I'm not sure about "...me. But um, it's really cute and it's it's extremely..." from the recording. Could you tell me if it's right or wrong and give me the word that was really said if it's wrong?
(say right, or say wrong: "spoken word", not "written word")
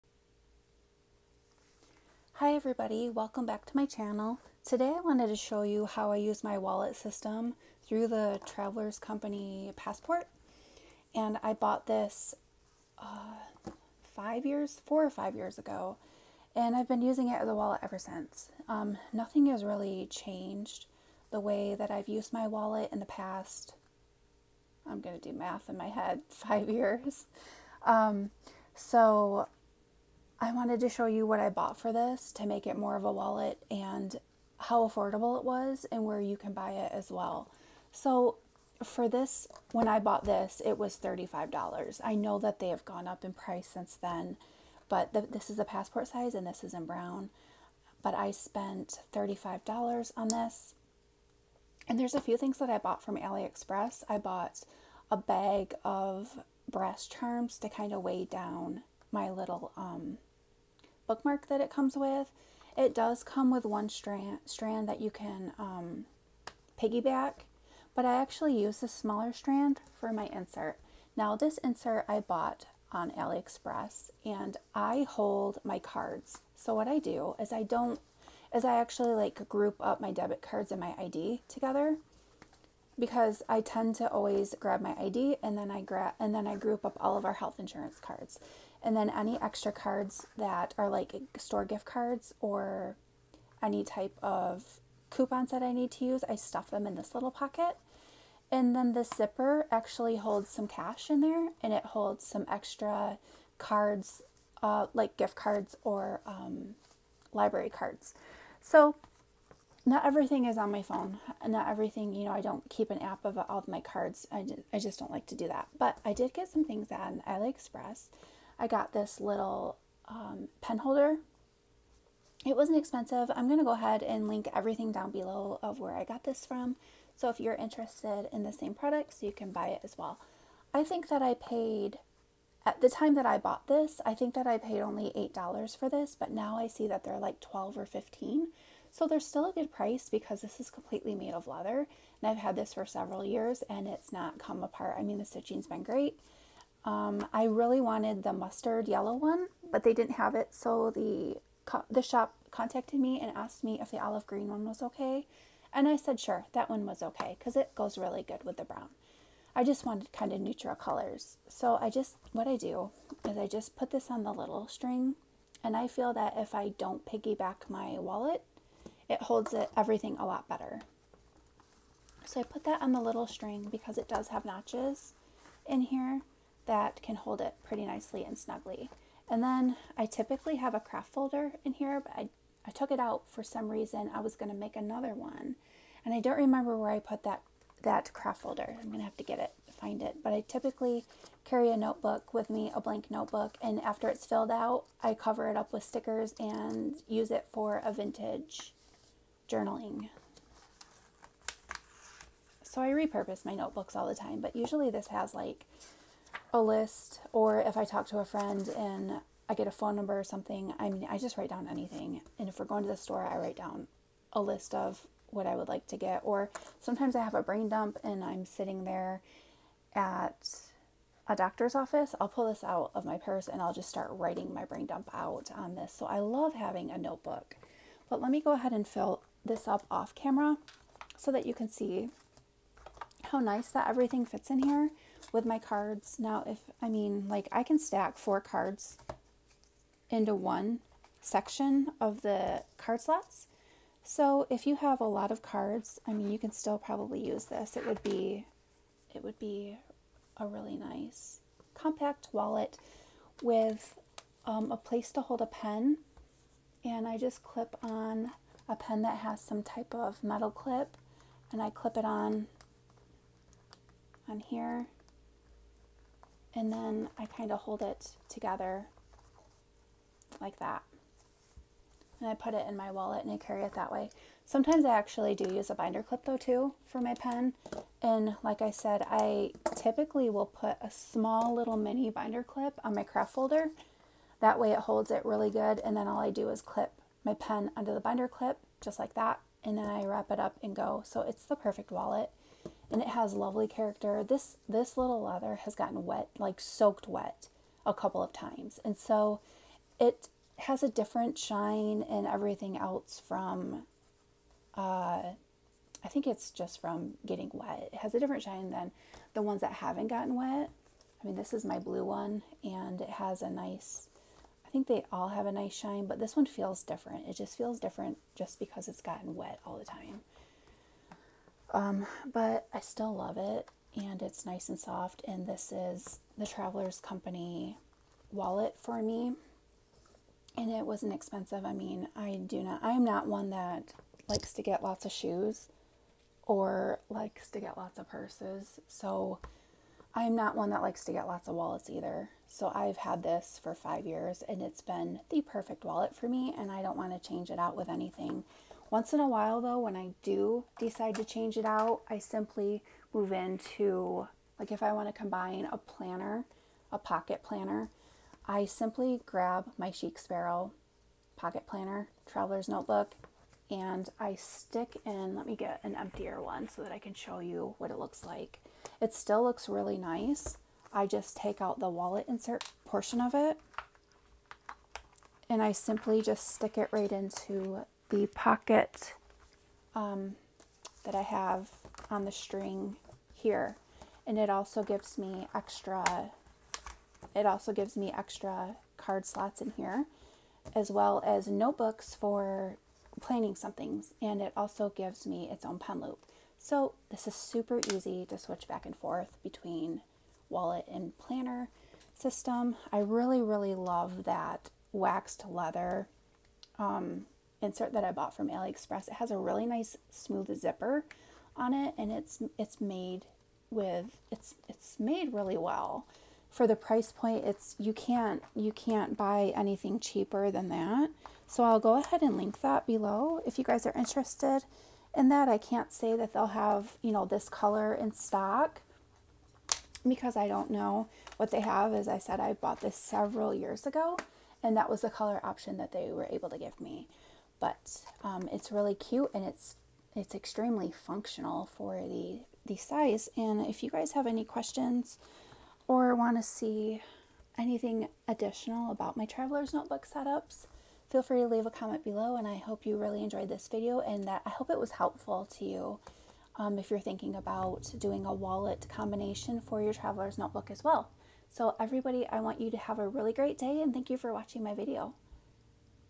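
right.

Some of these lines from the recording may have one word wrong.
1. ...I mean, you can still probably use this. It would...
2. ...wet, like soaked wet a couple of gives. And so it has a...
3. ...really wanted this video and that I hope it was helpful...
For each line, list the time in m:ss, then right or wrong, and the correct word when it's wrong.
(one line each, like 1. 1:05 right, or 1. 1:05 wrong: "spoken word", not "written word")
1. 4:06 right
2. 4:56 wrong: "times", not "gives"
3. 7:32 wrong: "enjoyed", not "wanted".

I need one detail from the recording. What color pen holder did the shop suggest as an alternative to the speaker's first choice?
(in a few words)
Olive green.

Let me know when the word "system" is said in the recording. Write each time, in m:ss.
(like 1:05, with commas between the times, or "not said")
0:06, 6:42.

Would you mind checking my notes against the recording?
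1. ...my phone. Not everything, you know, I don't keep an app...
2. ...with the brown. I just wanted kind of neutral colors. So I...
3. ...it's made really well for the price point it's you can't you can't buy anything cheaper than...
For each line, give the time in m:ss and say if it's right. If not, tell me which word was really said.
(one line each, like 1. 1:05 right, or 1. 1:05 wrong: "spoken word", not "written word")
1. 1:50 right
2. 2:38 right
3. 6:54 right.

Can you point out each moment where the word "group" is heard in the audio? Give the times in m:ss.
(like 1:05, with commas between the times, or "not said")
1:19, 1:26.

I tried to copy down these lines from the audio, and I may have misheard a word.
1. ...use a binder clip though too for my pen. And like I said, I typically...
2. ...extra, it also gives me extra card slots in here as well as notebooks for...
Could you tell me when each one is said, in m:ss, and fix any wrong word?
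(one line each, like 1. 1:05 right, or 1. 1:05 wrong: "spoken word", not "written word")
1. 4:35 right
2. 6:25 right.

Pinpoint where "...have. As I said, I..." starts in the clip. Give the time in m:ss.
7:11.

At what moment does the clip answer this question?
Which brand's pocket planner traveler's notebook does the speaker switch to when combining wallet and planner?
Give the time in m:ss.
5:59.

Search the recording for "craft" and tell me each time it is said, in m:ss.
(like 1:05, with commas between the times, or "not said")
3:00, 3:08, 4:43.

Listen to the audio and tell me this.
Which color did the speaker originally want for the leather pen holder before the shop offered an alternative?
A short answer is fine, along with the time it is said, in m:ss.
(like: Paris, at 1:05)
Mustard yellow, at 2:28.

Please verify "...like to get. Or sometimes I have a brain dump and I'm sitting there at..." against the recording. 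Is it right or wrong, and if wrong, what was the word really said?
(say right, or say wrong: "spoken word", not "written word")
right.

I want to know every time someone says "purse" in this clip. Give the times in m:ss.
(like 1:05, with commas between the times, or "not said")
3:43, 5:38.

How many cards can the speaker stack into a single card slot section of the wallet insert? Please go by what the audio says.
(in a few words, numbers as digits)
4.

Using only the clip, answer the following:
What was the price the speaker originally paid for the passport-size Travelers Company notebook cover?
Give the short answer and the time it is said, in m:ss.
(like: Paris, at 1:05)
$35, at 0:40.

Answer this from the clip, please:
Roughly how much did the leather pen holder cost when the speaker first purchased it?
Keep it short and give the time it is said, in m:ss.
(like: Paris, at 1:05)
$8, at 2:15.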